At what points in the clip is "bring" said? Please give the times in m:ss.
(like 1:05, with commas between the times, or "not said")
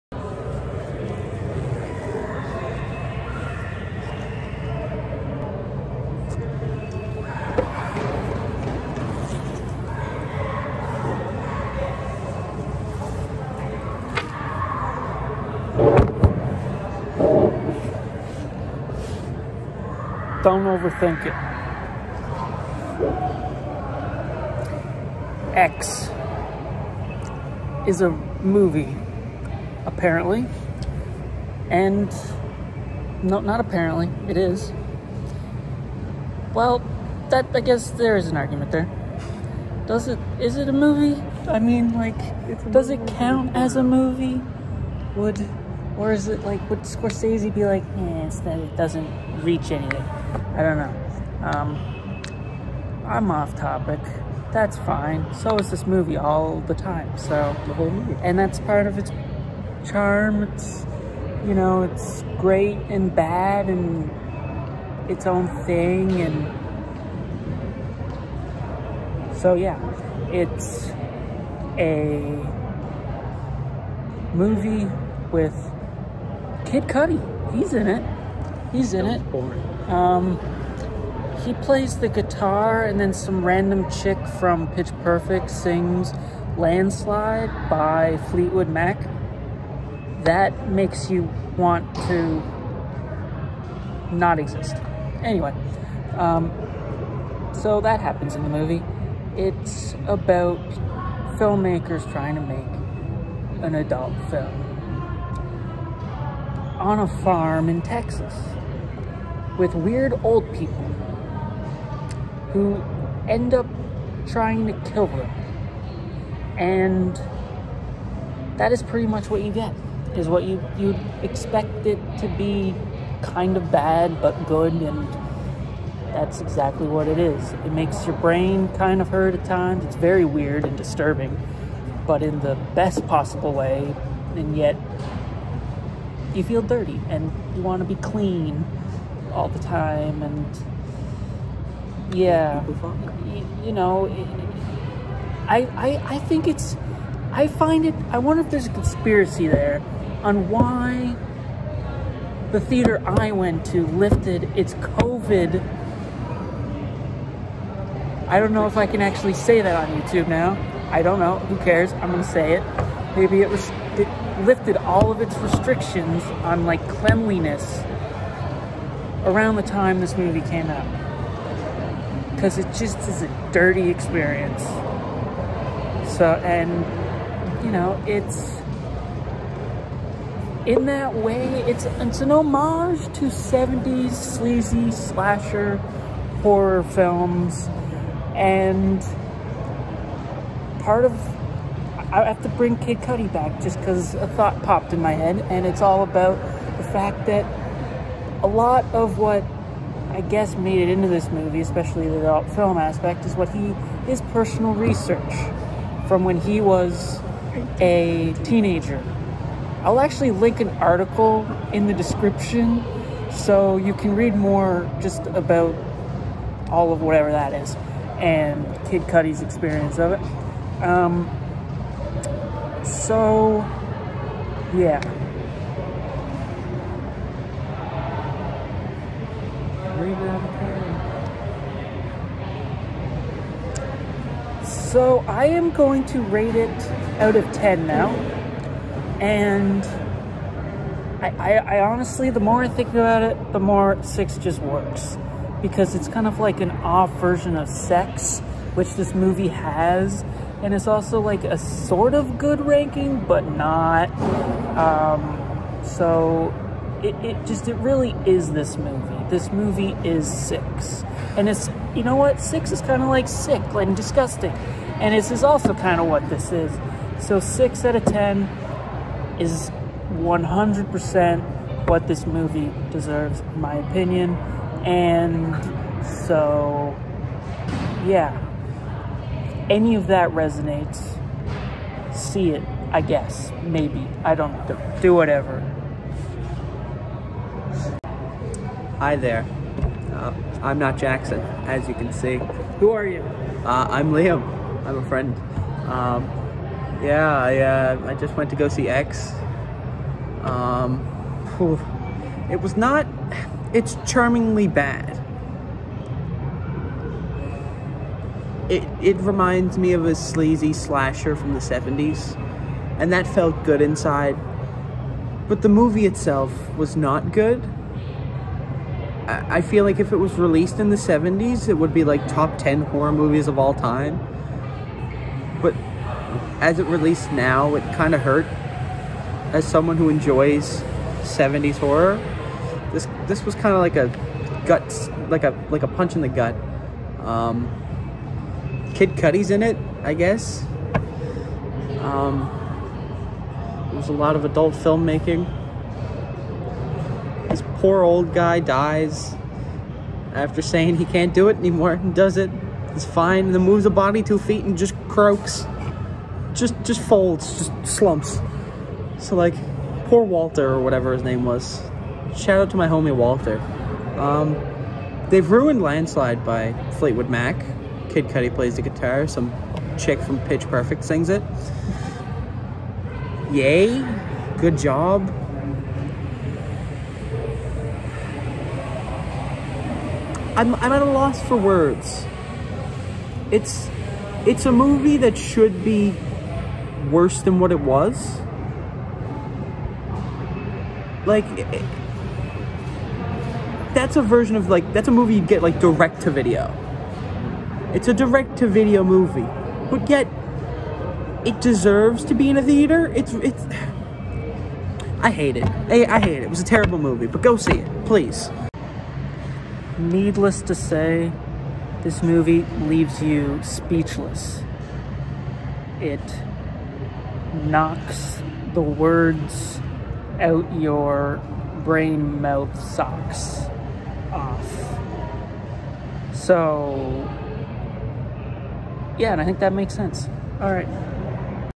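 3:12.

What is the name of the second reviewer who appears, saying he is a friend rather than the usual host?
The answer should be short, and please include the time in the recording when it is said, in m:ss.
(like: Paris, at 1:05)
Liam, at 4:54.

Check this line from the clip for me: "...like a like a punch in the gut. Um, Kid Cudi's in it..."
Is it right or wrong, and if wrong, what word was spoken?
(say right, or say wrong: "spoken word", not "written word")
right.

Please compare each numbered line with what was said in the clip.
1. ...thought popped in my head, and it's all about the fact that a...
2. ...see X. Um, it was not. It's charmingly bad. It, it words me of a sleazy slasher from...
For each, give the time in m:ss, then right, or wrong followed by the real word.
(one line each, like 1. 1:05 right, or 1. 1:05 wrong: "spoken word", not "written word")
1. 3:14 right
2. 4:58 wrong: "reminds", not "words".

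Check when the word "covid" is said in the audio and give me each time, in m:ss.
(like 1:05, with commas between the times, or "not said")
2:34.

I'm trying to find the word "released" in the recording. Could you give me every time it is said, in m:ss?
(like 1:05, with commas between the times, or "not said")
5:20, 5:26.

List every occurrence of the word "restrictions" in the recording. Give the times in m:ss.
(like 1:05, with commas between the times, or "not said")
2:45.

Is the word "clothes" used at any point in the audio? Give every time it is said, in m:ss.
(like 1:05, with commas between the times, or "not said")
not said.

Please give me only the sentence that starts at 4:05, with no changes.
Because it's kind of like an off version of sex, which this movie has.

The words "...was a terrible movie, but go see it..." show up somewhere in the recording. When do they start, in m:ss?
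6:46.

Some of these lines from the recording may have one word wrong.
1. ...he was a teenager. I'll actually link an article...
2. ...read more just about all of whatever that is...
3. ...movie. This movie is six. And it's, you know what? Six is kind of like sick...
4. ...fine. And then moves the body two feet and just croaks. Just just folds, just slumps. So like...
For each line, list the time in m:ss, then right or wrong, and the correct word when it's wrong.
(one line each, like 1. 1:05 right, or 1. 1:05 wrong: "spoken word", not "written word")
1. 3:26 right
2. 3:34 right
3. 4:18 right
4. 5:53 right.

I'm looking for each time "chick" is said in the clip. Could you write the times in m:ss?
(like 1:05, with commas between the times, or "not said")
1:23, 6:09.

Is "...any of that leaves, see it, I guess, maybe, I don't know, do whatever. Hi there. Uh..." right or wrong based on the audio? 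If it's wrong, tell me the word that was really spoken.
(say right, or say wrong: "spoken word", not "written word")
wrong: "resonates", not "leaves".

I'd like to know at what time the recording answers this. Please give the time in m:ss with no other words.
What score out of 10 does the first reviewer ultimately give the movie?
4:27.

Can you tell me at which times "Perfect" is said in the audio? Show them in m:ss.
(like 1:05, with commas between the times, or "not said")
1:25, 6:10.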